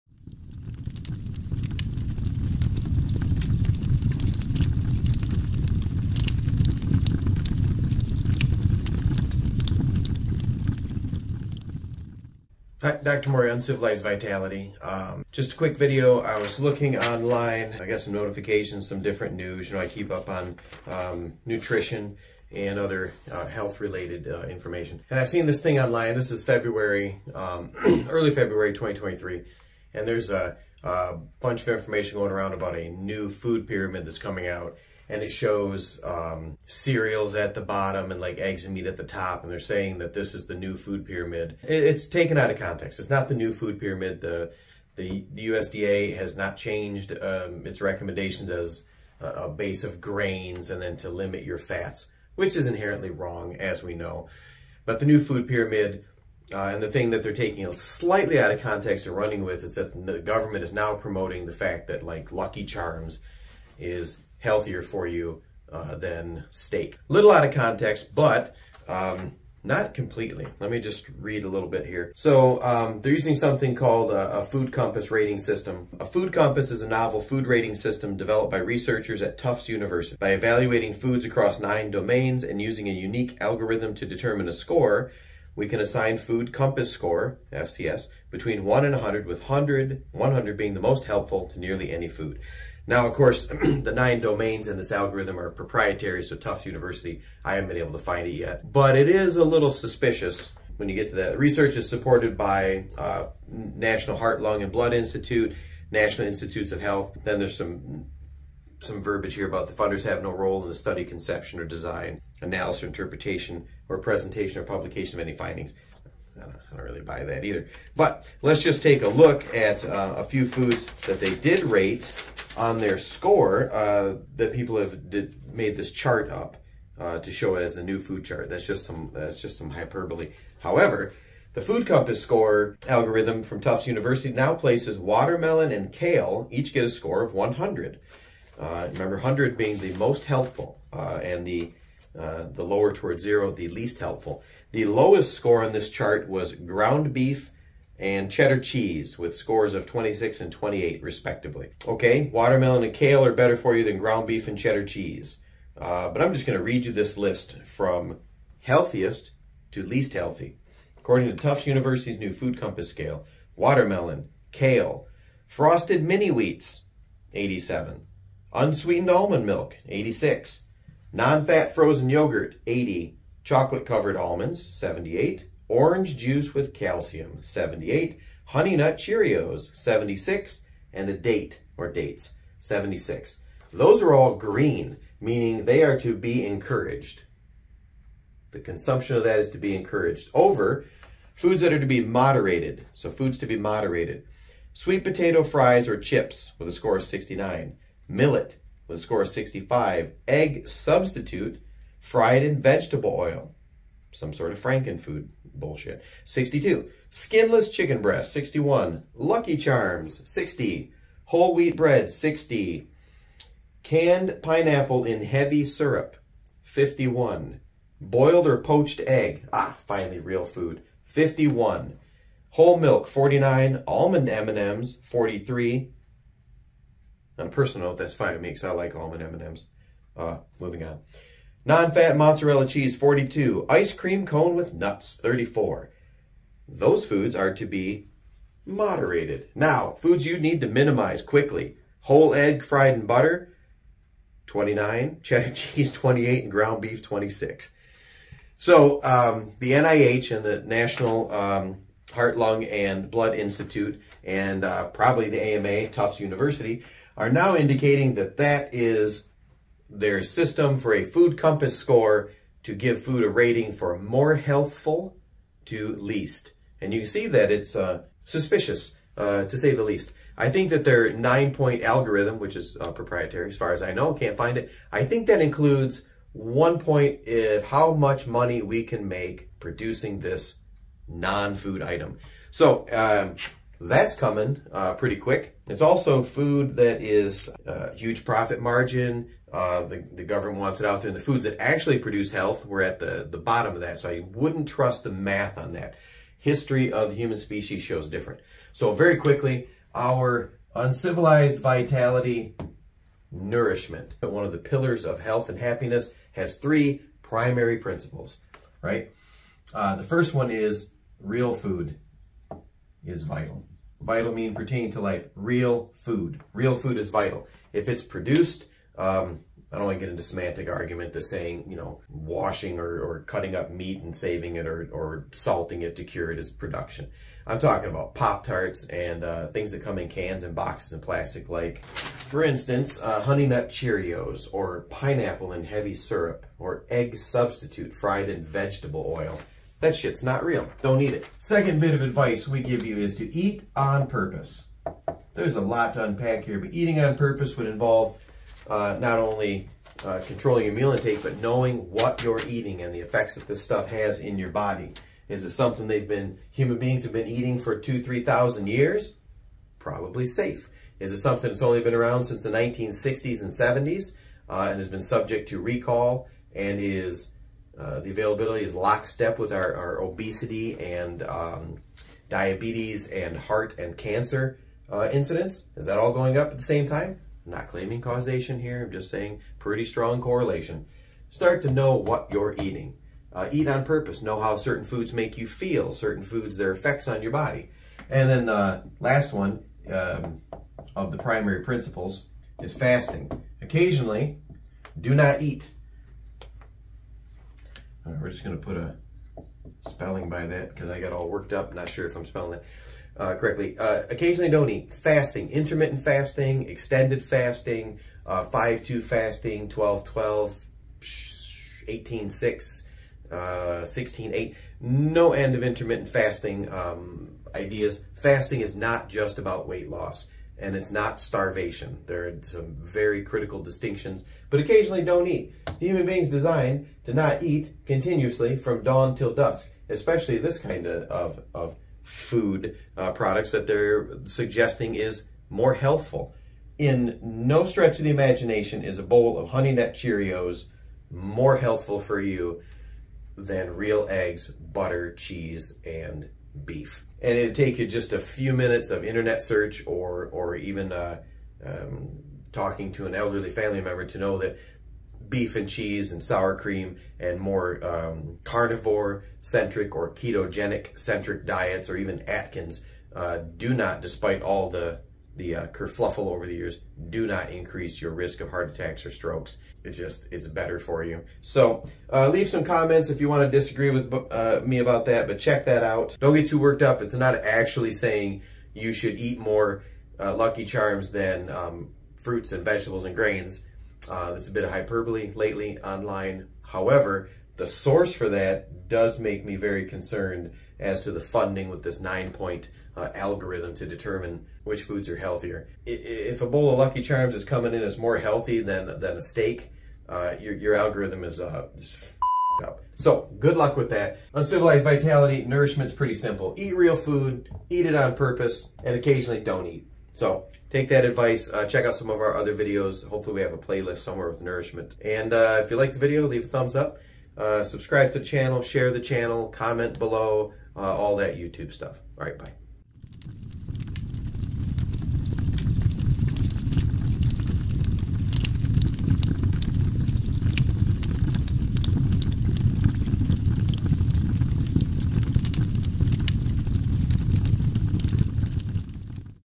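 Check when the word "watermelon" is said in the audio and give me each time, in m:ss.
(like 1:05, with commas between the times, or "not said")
2:14, 2:32, 2:43.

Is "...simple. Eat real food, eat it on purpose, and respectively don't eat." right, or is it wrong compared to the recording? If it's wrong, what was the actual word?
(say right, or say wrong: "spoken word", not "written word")
wrong: "occasionally", not "respectively".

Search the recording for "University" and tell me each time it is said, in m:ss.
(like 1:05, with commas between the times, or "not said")
1:19, 1:36, 2:13, 2:41, 4:16.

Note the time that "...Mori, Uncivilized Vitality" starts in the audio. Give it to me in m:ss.
0:13.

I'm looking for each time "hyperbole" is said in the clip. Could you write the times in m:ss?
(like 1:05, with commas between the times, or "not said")
2:09, 8:04.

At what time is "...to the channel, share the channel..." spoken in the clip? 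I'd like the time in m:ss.
8:38.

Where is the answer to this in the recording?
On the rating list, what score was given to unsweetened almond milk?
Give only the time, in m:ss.
2:49.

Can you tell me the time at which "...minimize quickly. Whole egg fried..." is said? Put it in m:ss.
4:00.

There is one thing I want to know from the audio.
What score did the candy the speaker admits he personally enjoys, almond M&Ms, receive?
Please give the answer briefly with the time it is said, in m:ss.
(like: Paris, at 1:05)
43, at 3:45.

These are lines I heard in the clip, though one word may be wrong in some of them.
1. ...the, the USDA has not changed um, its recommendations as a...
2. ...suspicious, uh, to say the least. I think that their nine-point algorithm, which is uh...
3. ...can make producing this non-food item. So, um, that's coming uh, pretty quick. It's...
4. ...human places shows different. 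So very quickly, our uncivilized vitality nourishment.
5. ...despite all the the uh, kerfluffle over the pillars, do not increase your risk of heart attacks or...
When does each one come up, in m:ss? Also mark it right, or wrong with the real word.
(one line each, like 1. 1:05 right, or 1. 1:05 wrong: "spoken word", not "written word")
1. 0:44 right
2. 4:28 right
3. 4:38 right
4. 4:57 wrong: "species", not "places"
5. 7:44 wrong: "years", not "pillars".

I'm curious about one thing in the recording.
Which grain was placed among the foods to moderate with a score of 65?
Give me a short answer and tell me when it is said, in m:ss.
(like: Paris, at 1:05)
Millet, at 3:18.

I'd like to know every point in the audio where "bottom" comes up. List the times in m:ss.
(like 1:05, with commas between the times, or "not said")
0:37, 4:53.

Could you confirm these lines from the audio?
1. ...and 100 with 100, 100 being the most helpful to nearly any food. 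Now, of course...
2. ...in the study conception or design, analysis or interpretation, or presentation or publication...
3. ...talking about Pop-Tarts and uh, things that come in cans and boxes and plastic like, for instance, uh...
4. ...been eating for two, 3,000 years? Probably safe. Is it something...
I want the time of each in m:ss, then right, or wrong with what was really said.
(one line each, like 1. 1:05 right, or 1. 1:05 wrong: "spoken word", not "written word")
1. 1:28 right
2. 1:50 right
3. 5:27 right
4. 5:57 right.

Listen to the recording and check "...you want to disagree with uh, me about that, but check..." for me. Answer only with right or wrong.
right.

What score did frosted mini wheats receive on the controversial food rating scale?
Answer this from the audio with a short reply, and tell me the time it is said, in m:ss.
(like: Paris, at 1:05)
87, at 2:47.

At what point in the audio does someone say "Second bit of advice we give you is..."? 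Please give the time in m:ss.
5:41.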